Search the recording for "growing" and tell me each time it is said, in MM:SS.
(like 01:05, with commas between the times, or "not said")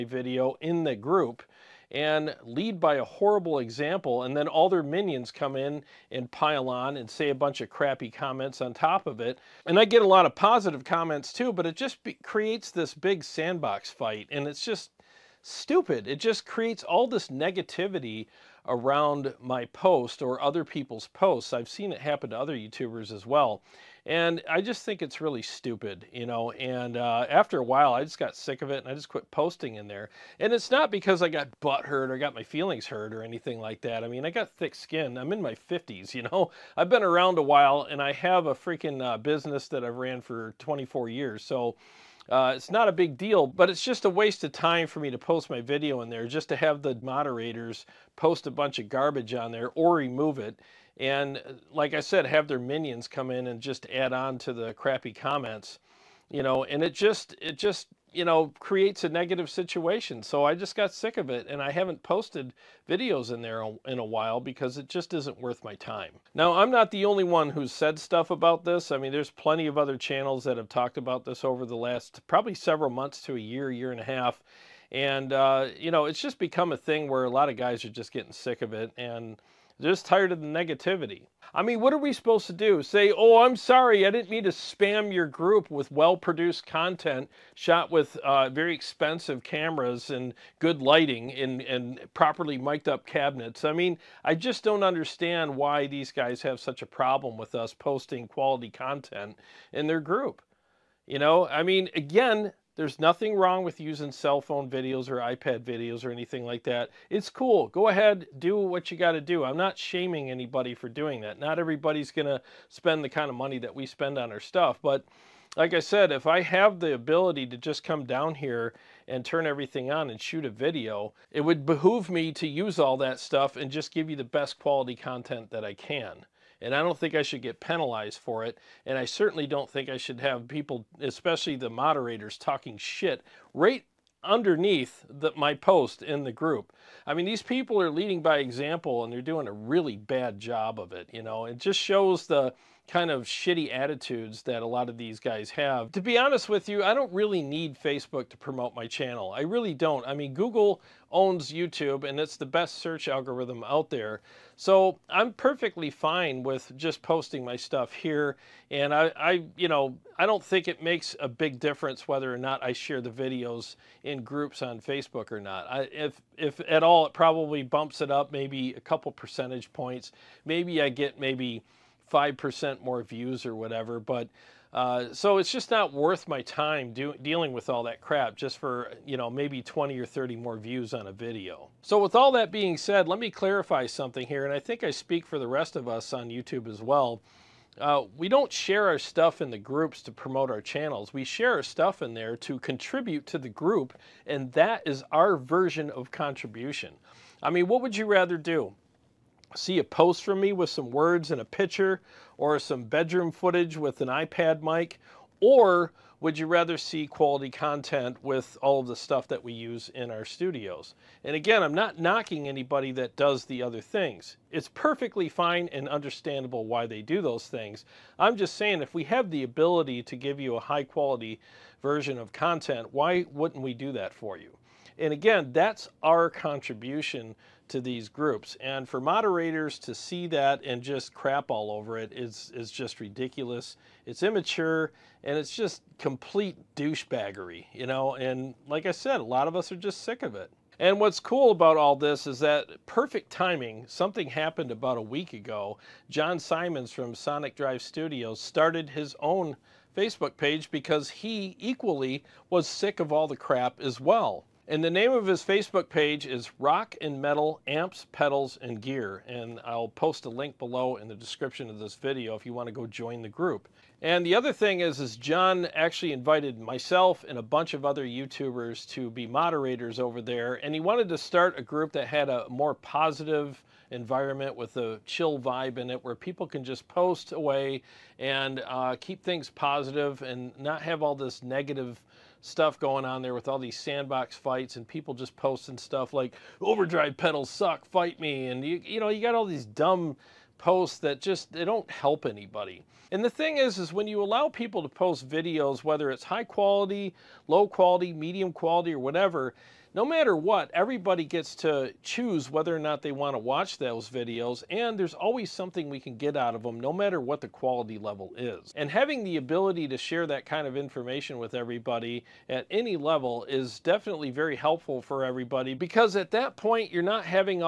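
not said.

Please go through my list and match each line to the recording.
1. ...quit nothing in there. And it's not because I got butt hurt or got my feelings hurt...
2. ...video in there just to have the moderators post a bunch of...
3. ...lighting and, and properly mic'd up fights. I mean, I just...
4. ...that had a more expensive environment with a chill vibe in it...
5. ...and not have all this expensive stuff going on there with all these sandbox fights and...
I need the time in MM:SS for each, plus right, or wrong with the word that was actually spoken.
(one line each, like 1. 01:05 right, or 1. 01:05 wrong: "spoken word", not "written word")
1. 00:29 wrong: "posting", not "nothing"
2. 00:45 right
3. 01:30 wrong: "cabinets", not "fights"
4. 04:31 wrong: "positive", not "expensive"
5. 04:40 wrong: "negative", not "expensive".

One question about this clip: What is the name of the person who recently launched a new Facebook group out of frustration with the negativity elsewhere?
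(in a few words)
Jon Simons.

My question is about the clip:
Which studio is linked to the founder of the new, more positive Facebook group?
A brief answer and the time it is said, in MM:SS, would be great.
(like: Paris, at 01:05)
Sonic Drive Studios, at 04:07.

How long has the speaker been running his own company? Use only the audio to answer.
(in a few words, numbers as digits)
24 years.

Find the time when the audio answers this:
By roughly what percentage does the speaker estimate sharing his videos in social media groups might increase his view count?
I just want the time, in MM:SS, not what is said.
02:52.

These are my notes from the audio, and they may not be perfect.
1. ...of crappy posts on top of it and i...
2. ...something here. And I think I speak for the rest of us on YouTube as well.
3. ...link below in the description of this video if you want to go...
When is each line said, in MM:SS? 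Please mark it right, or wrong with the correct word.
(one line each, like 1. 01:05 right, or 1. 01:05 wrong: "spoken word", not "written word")
1. 00:07 wrong: "comments", not "posts"
2. 03:03 right
3. 04:20 right.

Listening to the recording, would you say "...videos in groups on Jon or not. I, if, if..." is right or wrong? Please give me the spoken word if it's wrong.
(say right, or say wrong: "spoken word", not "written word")
wrong: "Facebook", not "Jon".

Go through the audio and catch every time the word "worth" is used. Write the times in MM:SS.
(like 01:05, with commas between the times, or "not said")
01:05, 02:55.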